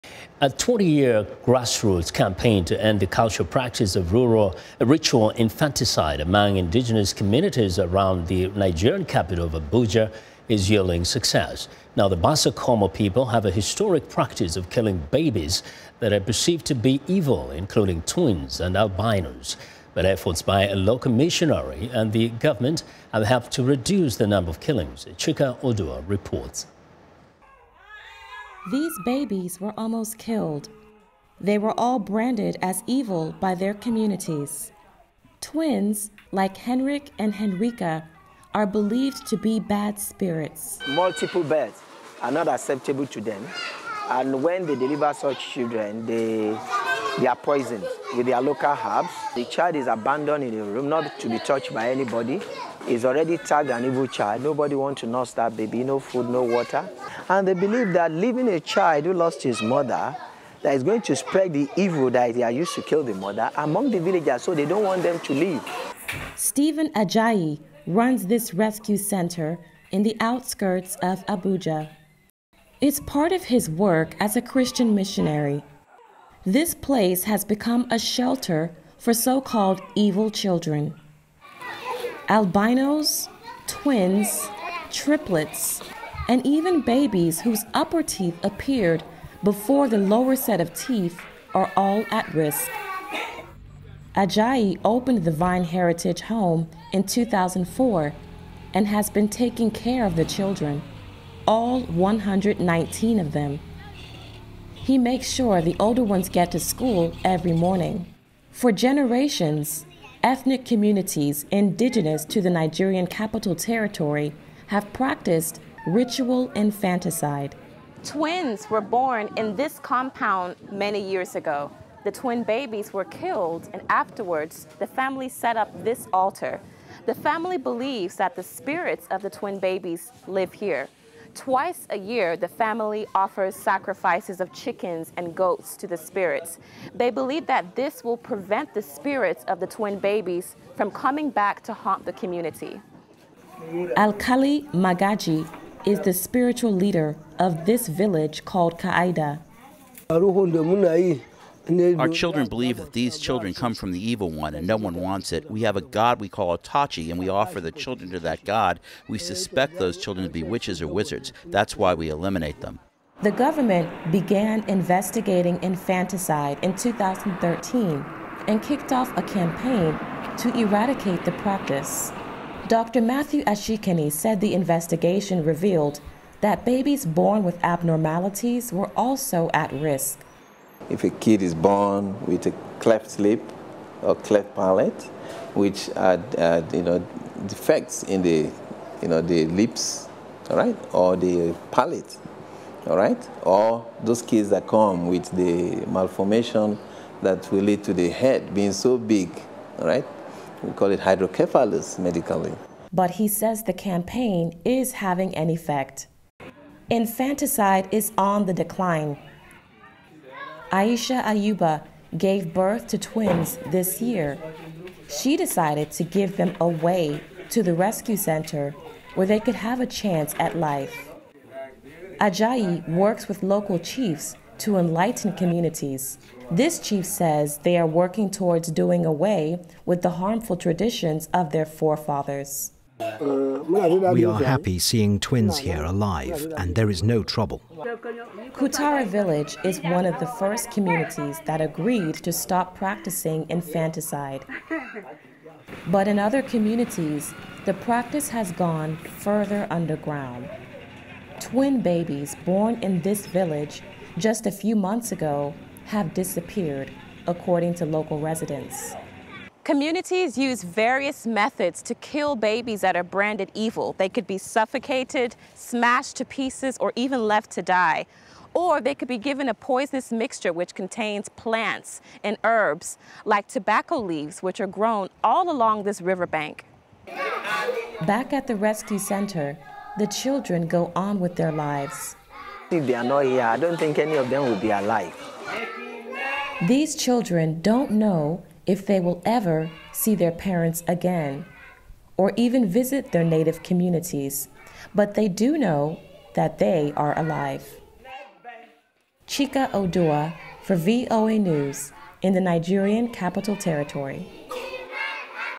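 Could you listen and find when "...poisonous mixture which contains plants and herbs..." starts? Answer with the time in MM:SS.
04:29.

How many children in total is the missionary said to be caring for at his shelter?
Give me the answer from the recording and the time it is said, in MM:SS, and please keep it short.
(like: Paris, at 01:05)
119, at 01:41.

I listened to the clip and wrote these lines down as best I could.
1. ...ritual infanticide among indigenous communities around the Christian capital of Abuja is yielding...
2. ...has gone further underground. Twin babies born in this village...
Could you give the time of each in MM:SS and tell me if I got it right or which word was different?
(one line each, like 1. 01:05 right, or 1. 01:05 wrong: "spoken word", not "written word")
1. 00:04 wrong: "Nigerian", not "Christian"
2. 04:08 right.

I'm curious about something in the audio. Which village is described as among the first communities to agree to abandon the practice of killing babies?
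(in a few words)
Kutara.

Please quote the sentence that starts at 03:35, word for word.
She decided to give them away to the rescue center where they could have a chance at life.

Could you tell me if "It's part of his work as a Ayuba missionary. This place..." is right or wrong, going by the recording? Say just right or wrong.
wrong.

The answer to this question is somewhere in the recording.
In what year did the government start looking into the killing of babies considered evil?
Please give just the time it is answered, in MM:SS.
02:46.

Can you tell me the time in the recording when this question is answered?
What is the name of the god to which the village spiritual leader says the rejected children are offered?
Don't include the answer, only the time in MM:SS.
02:36.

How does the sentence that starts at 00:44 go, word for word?
And when they deliver such children, they, they are poisoned with their local herbs.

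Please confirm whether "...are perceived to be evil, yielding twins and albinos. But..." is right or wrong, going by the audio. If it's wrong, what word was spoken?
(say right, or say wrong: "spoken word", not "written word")
wrong: "including", not "yielding".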